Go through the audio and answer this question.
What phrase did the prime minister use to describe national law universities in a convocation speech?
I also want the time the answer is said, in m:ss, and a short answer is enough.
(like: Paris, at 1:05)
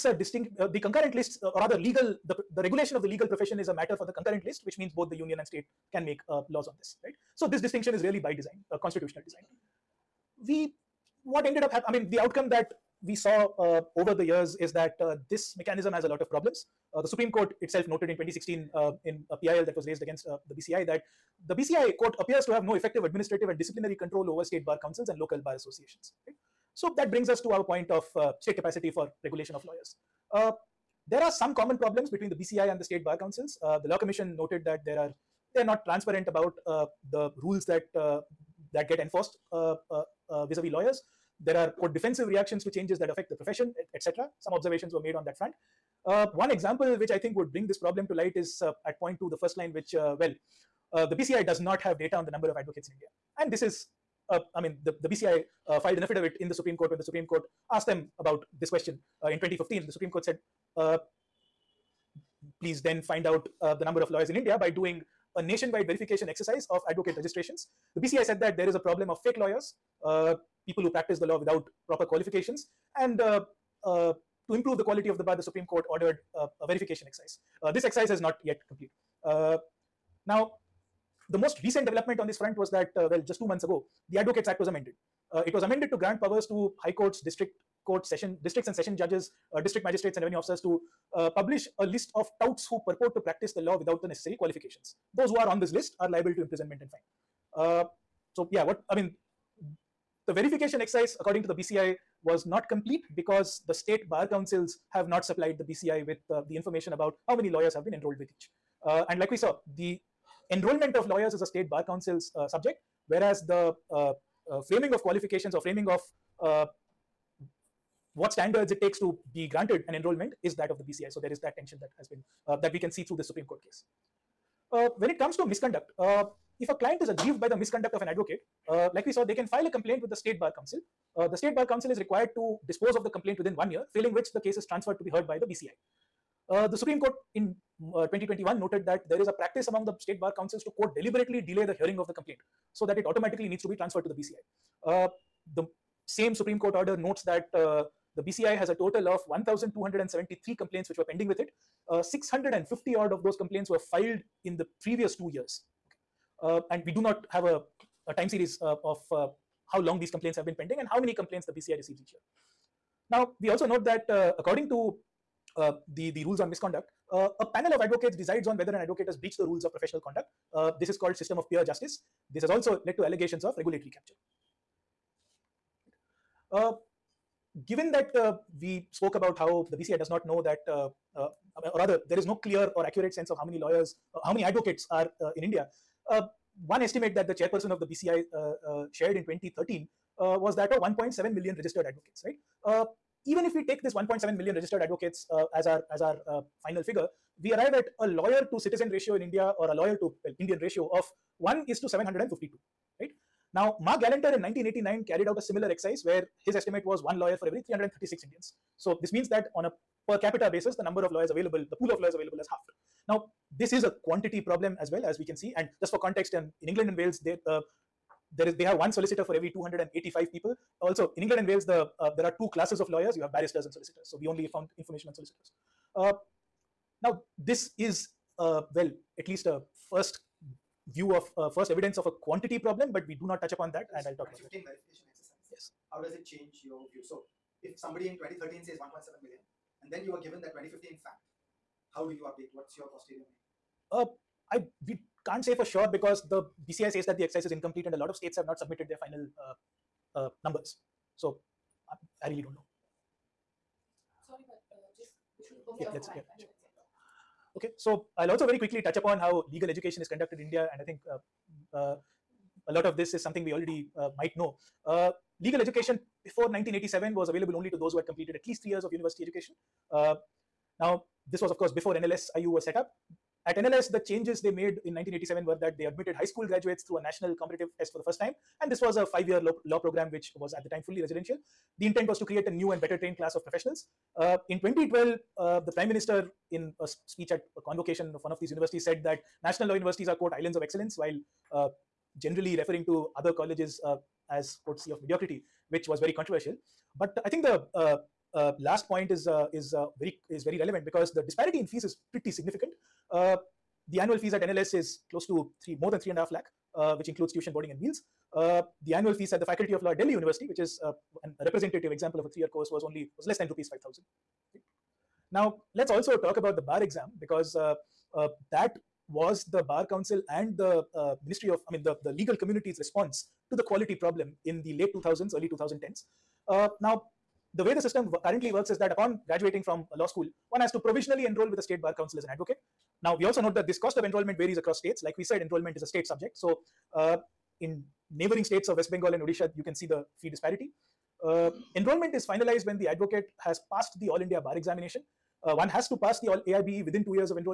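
islands of excellence, at 4:50.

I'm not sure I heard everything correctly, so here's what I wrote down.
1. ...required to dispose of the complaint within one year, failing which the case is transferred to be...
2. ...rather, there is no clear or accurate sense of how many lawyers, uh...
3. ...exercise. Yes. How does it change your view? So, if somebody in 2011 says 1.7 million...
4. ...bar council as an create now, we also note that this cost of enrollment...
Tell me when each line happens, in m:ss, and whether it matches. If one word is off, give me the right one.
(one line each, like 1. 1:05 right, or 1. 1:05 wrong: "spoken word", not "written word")
1. 2:11 right
2. 3:01 right
3. 3:55 wrong: "2013", not "2011"
4. 5:31 wrong: "advocate", not "create".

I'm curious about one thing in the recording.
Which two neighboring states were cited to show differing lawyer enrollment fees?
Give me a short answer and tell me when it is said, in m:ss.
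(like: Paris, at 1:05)
West Bengal and Odisha, at 5:38.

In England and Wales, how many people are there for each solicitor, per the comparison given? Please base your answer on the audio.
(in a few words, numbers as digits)
285.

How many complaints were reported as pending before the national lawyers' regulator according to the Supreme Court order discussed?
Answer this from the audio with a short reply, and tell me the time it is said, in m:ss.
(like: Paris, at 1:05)
1,273, at 2:29.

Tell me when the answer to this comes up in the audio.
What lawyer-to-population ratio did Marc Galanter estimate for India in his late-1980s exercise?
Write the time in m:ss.
3:27.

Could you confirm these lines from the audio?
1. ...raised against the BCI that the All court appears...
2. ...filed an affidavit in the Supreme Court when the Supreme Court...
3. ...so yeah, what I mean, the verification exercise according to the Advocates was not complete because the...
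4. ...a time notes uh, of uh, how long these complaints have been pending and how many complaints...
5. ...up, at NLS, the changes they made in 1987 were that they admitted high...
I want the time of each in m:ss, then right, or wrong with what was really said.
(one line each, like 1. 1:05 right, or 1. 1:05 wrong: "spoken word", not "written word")
1. 0:19 wrong: "BCI", not "All"
2. 0:55 right
3. 1:38 wrong: "BCI", not "Advocates"
4. 2:38 wrong: "series", not "notes"
5. 4:32 right.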